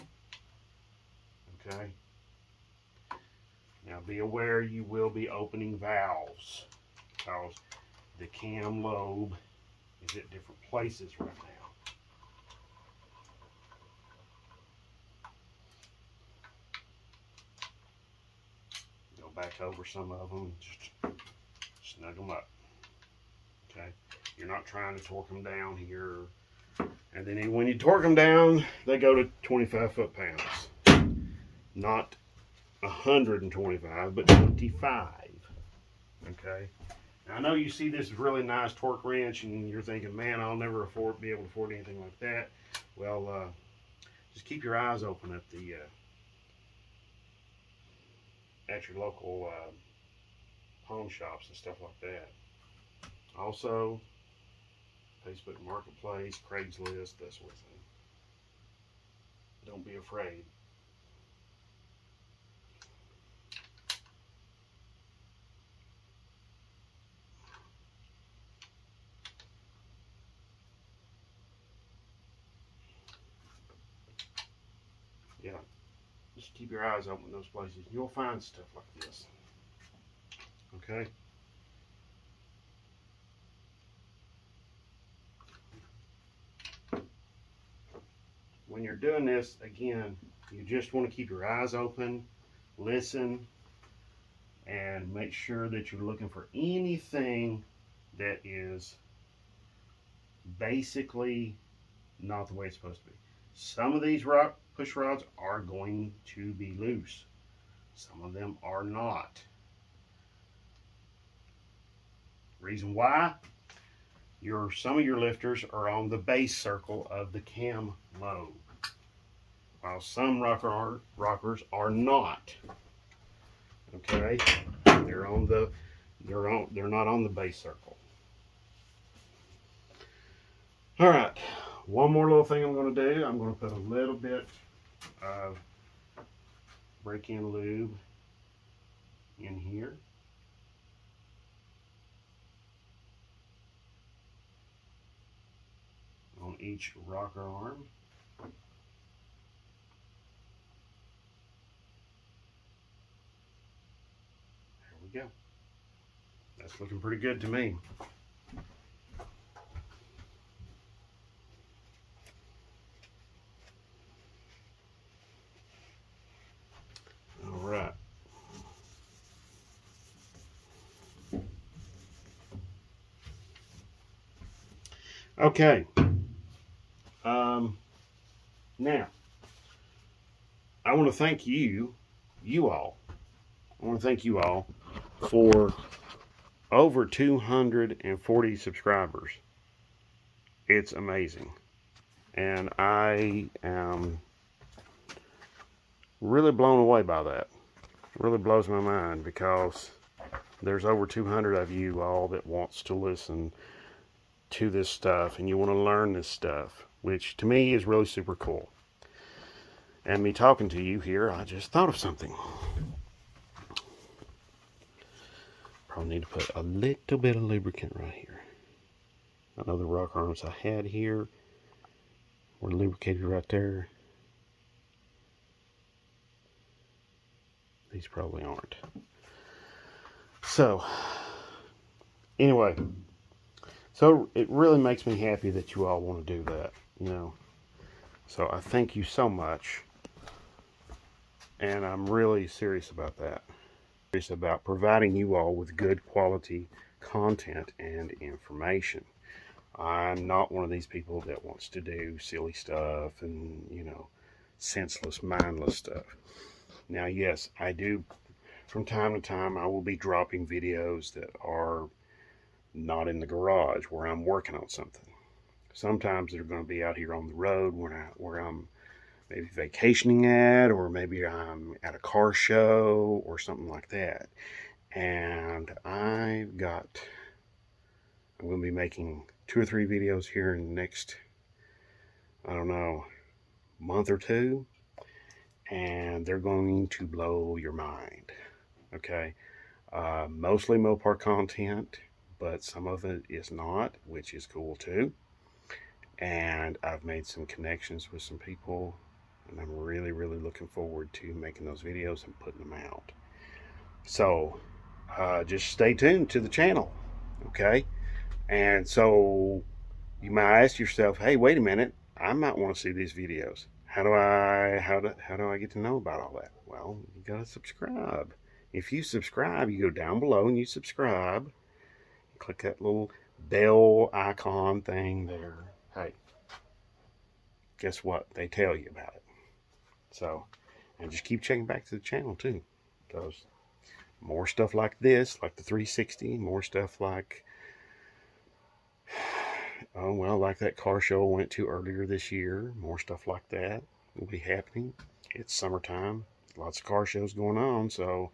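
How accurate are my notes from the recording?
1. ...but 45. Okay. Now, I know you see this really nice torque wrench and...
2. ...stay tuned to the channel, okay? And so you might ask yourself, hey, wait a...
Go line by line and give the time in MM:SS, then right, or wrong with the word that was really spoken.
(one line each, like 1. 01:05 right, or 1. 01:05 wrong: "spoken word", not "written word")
1. 00:34 wrong: "25", not "45"
2. 05:05 right.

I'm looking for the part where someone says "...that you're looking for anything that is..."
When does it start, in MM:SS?
01:35.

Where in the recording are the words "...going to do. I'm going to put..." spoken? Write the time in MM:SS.
02:12.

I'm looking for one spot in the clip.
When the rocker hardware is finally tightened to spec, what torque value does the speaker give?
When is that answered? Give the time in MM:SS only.
00:29.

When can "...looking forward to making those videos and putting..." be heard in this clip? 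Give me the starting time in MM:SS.
05:00.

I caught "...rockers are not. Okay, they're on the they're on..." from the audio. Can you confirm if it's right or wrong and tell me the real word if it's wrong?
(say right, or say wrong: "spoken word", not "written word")
right.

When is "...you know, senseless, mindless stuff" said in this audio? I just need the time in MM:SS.
04:13.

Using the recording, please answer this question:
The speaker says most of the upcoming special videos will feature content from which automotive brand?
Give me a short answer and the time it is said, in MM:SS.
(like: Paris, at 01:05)
Mopar, at 04:50.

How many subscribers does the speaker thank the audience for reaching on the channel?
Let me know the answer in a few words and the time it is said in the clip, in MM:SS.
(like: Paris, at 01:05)
over 240, at 03:06.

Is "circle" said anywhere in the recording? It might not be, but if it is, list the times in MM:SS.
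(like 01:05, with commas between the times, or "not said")
01:56, 02:07.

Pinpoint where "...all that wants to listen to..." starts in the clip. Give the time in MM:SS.
03:22.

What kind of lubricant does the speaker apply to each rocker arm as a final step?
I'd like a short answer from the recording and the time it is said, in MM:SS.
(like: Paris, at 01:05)
break-in lube, at 02:17.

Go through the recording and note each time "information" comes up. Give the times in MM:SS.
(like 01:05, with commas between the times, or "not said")
04:08.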